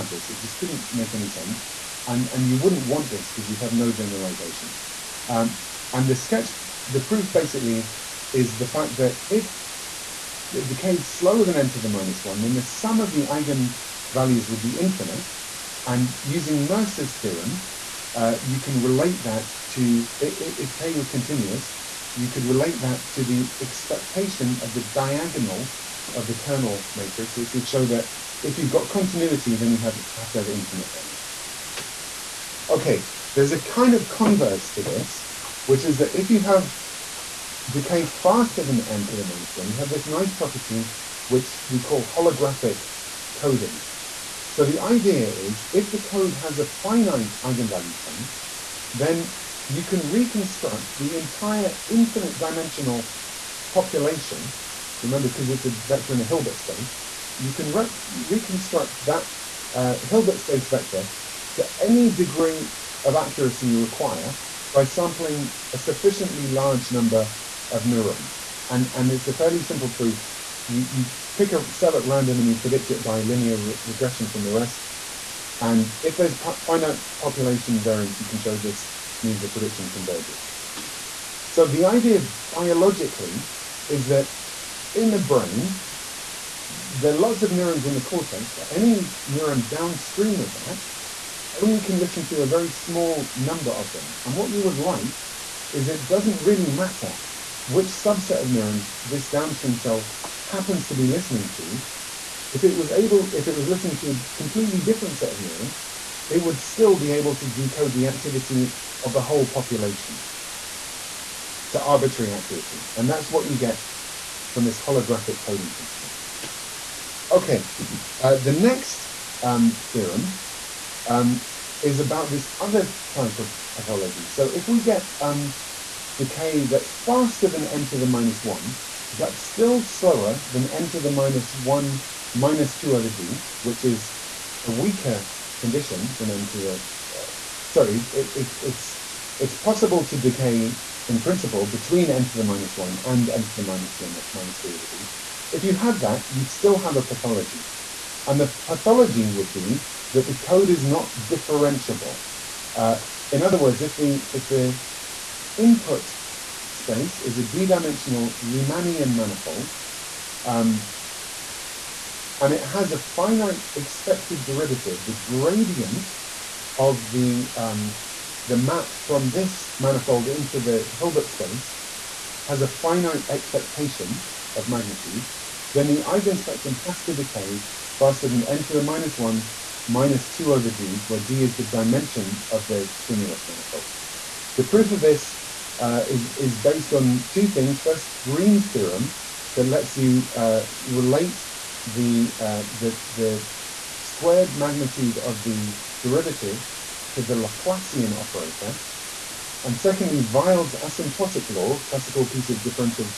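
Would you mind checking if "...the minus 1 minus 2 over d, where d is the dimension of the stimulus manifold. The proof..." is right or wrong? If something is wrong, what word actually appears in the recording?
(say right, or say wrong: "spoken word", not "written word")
right.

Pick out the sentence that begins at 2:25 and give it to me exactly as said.
If you had that, you'd still have a pathology.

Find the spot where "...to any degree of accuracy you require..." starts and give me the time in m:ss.
1:01.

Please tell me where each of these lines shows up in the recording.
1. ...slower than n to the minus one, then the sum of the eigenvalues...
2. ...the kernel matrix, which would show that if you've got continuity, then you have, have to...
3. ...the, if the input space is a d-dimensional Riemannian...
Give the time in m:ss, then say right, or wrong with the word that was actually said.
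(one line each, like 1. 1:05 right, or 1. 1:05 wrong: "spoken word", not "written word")
1. 0:11 right
2. 0:26 right
3. 2:33 right.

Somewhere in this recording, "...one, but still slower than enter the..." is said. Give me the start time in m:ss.
2:08.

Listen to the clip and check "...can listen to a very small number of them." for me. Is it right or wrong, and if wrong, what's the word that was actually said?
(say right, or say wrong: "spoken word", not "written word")
right.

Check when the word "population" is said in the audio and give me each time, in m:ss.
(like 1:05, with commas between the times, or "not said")
0:53, 1:17, 1:49.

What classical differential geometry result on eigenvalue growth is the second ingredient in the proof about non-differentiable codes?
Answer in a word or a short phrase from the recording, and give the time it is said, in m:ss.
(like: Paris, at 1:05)
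Weyl's asymptotic law, at 3:20.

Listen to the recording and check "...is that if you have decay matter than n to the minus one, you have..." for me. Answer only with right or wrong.
wrong.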